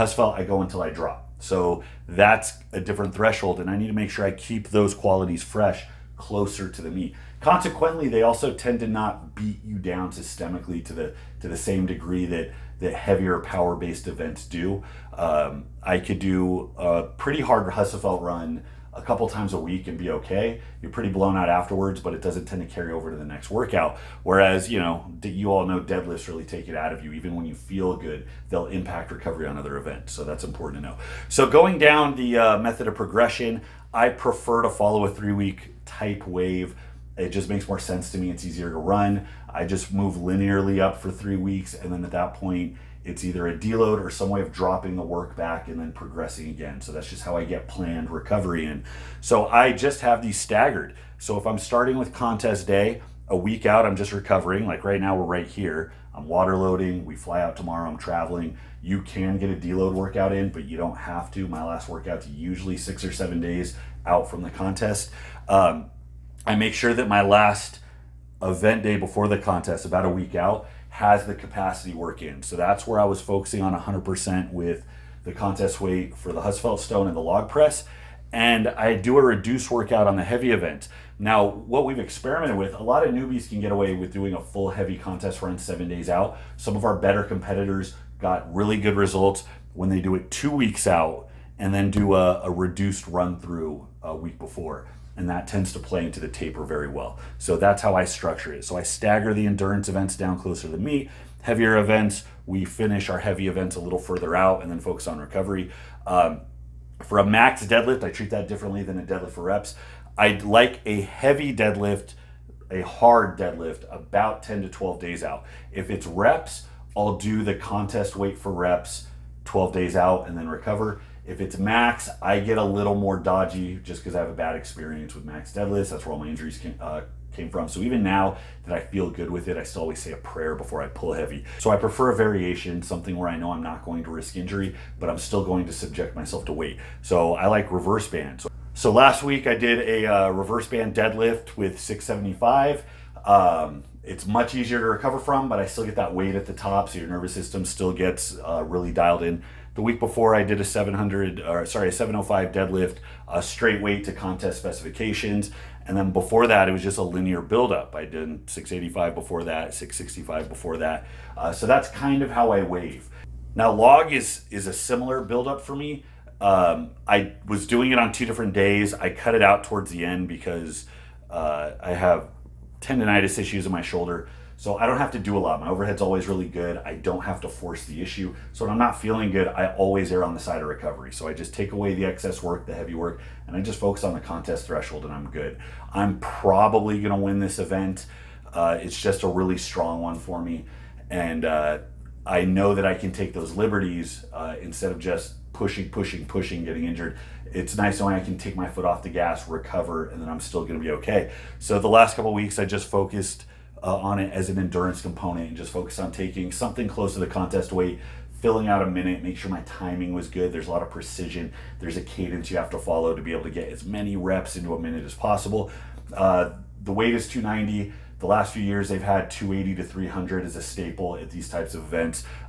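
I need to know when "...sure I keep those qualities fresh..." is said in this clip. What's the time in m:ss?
0:04.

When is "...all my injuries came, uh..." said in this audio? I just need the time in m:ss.
2:06.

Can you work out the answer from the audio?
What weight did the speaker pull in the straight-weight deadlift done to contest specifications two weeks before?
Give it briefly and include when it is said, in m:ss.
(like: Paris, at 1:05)
705, at 2:31.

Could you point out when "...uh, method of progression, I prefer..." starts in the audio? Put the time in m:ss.
0:32.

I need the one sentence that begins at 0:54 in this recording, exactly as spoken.
Like right now, we're right here.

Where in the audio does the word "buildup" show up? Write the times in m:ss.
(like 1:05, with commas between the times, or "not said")
2:37, 2:45.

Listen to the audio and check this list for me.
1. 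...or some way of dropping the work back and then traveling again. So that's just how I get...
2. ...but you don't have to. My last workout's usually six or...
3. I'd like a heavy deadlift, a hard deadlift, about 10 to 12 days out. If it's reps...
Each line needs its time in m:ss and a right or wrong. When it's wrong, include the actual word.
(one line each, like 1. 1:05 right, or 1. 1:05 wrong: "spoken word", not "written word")
1. 0:44 wrong: "progressing", not "traveling"
2. 1:00 right
3. 1:50 right.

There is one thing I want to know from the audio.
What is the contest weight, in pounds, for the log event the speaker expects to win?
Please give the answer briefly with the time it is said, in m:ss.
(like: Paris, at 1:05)
290, at 3:37.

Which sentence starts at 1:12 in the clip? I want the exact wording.
So that's where I was focusing on 100% with the contest weight for the Husafell Stone and the log press.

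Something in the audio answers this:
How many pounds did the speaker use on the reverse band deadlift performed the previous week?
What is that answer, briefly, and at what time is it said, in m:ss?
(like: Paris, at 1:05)
675, at 2:21.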